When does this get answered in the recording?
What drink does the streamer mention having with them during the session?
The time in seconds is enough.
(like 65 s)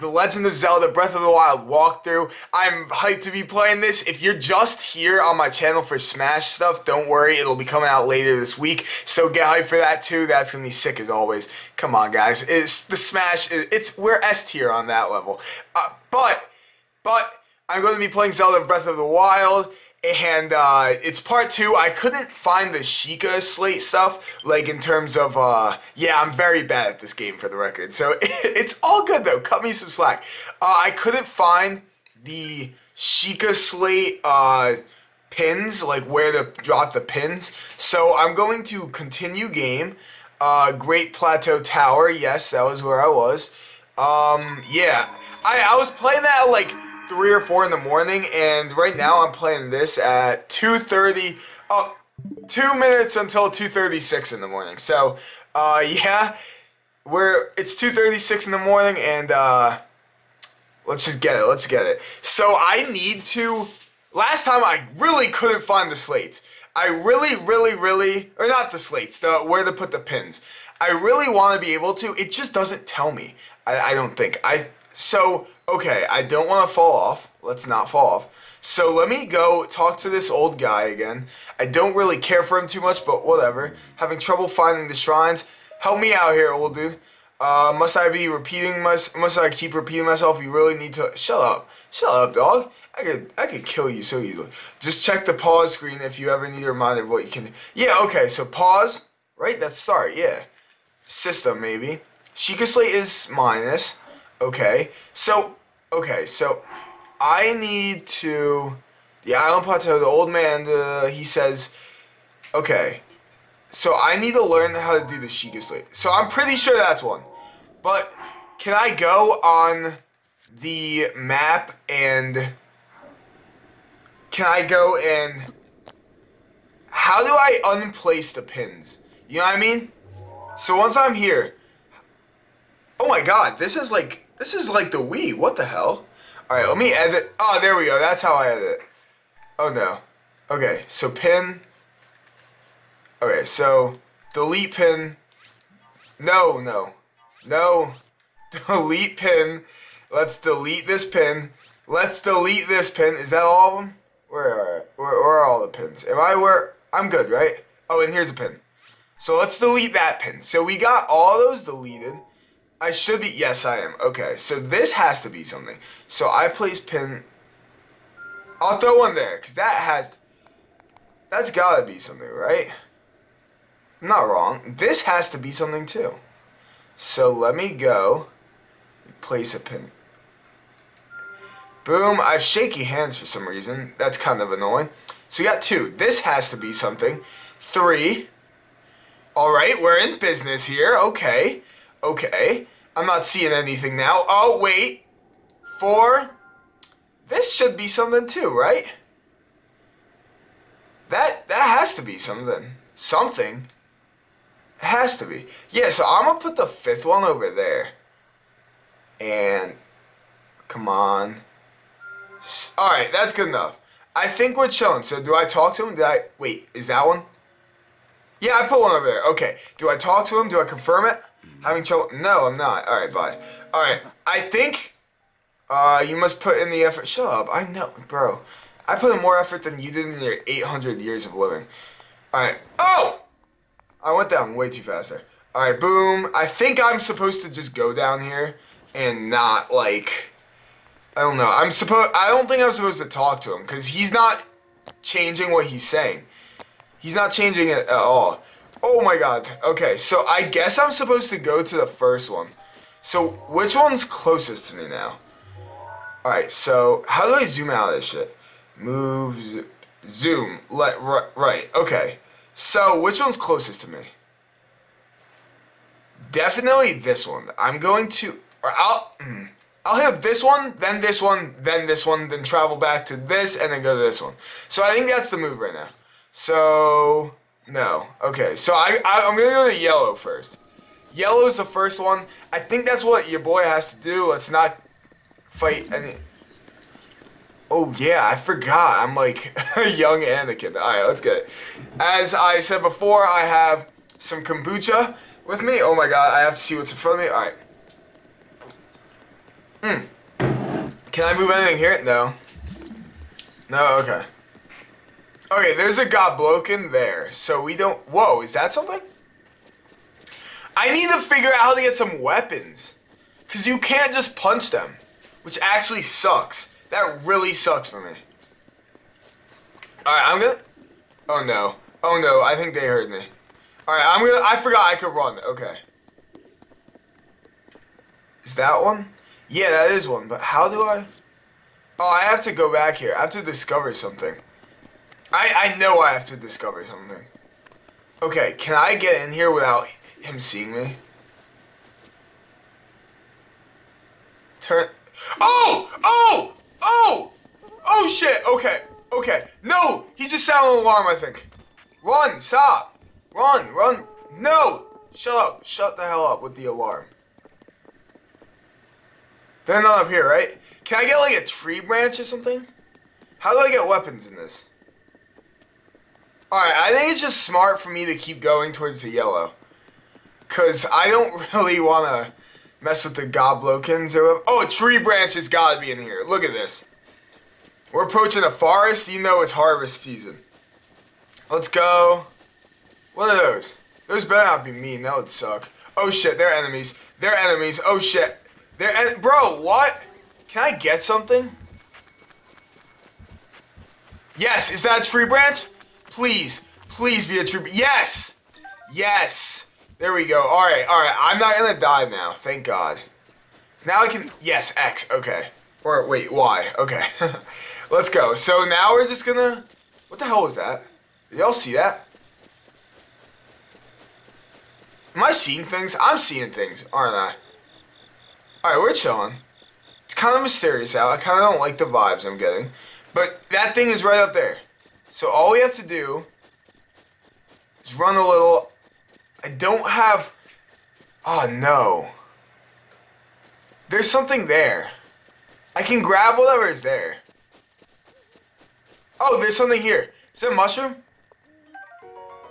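294 s.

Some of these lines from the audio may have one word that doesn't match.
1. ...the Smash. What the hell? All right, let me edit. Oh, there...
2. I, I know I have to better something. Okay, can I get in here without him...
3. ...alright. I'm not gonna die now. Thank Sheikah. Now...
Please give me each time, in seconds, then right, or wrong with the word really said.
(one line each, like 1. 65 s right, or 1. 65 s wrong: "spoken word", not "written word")
1. 134 s wrong: "Wii", not "Smash"
2. 335 s wrong: "discover", not "better"
3. 400 s wrong: "God", not "Sheikah".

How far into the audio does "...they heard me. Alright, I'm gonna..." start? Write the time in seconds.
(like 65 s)
322 s.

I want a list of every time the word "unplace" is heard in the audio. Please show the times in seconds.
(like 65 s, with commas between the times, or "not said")
127 s.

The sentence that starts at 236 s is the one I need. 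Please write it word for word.
I think I'm supposed to just go down here and not, like...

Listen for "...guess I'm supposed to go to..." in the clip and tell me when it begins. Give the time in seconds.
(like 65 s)
250 s.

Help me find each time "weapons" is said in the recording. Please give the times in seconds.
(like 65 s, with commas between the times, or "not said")
312 s, 363 s.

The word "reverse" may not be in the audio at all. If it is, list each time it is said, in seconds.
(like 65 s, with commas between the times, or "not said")
not said.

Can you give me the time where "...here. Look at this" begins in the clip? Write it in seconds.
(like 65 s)
375 s.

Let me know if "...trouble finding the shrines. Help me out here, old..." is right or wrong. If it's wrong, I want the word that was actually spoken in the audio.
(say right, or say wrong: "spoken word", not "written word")
right.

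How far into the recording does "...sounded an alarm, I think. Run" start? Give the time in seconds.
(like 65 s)
350 s.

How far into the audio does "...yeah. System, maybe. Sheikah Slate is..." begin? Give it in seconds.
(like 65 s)
100 s.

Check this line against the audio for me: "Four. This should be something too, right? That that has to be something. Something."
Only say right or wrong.
right.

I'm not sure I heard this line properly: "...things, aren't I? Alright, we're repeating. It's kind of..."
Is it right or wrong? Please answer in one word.
wrong.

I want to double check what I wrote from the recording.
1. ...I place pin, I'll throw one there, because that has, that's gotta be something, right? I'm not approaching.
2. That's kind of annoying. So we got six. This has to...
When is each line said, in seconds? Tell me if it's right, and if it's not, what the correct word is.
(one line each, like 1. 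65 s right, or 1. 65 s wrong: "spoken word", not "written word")
1. 166 s wrong: "wrong", not "approaching"
2. 183 s wrong: "two", not "six".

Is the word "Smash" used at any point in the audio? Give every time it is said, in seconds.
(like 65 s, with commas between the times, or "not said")
5 s, 12 s.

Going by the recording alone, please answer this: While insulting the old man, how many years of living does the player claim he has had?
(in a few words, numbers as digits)
800.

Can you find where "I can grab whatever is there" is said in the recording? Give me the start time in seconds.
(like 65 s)
435 s.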